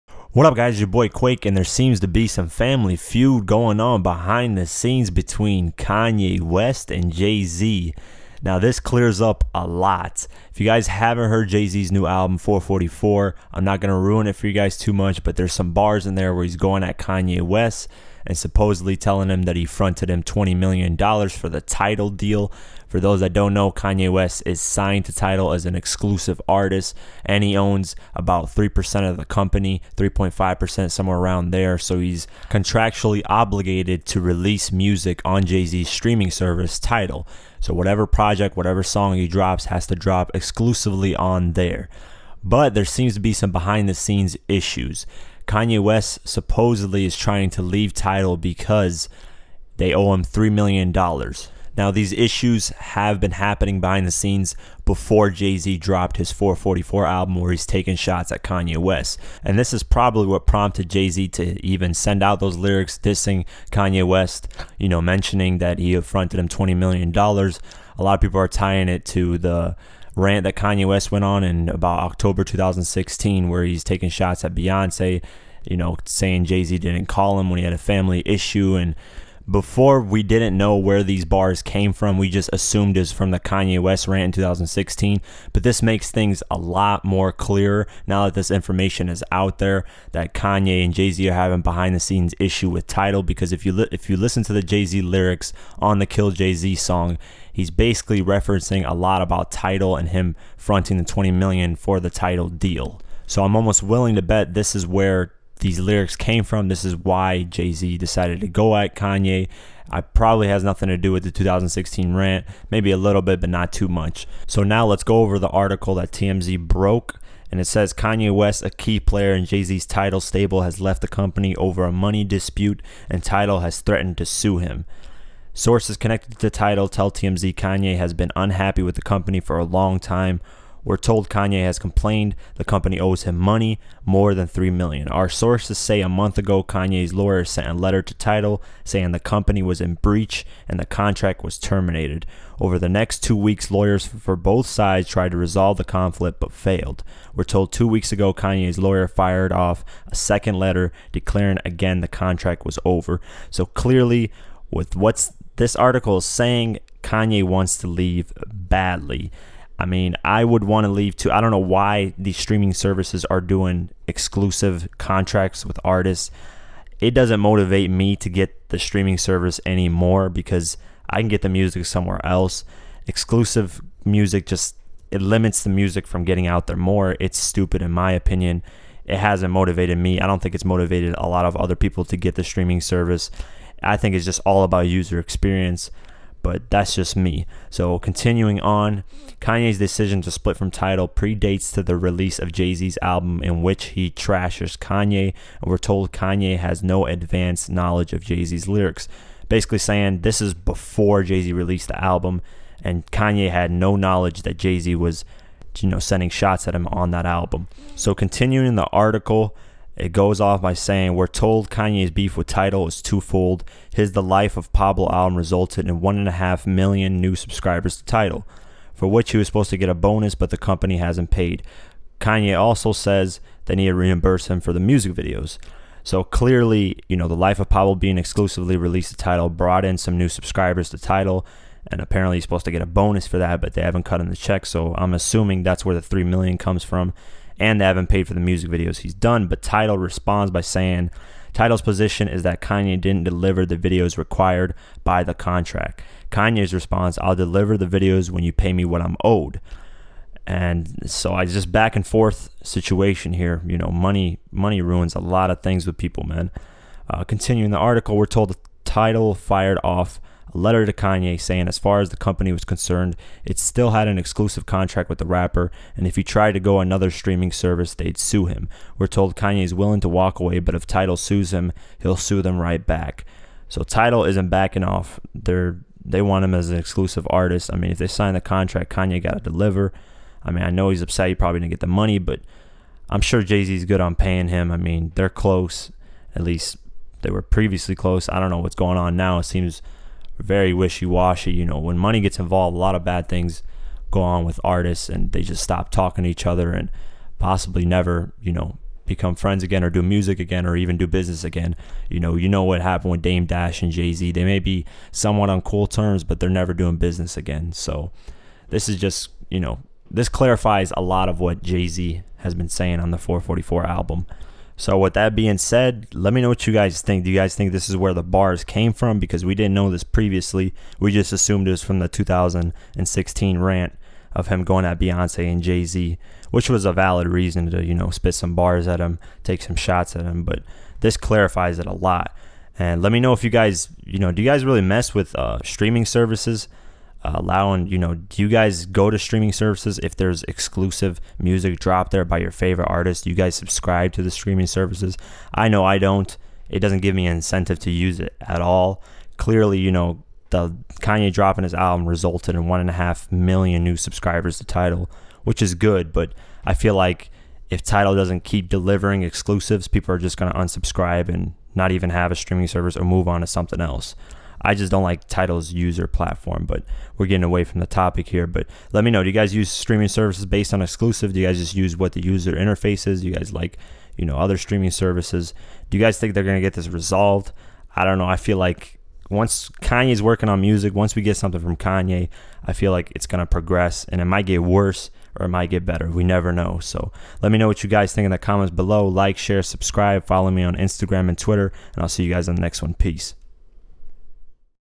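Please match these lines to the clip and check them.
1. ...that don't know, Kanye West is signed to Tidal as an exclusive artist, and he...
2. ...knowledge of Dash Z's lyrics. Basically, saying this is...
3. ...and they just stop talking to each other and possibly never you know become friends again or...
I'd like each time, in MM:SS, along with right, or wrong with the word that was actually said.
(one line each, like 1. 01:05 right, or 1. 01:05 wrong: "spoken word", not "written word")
1. 00:23 right
2. 03:17 wrong: "Jay", not "Dash"
3. 04:55 right.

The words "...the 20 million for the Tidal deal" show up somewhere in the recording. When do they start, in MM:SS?
01:40.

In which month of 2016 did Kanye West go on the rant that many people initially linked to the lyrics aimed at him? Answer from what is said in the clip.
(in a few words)
October.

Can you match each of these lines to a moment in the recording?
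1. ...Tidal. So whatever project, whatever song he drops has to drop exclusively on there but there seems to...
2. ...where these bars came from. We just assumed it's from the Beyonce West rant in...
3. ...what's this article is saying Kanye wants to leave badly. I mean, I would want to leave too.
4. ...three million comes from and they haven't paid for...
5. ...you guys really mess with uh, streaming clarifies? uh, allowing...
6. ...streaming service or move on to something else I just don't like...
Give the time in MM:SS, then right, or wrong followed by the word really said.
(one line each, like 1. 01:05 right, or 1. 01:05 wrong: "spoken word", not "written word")
1. 00:36 right
2. 01:20 wrong: "Kanye", not "Beyonce"
3. 02:34 right
4. 03:56 right
5. 05:34 wrong: "services", not "clarifies"
6. 06:02 right.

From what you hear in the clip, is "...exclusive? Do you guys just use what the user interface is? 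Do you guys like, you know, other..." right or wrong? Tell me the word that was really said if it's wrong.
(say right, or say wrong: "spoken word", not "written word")
right.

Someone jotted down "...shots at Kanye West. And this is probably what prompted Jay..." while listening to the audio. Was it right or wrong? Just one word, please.
right.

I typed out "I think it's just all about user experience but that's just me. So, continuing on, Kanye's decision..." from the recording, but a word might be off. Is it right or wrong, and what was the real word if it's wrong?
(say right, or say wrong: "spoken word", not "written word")
right.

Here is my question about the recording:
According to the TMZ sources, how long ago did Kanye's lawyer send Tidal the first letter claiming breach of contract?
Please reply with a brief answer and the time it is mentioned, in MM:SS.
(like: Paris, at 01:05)
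A month ago, at 02:16.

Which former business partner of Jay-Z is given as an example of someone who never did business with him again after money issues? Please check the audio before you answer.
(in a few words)
Dame Dash.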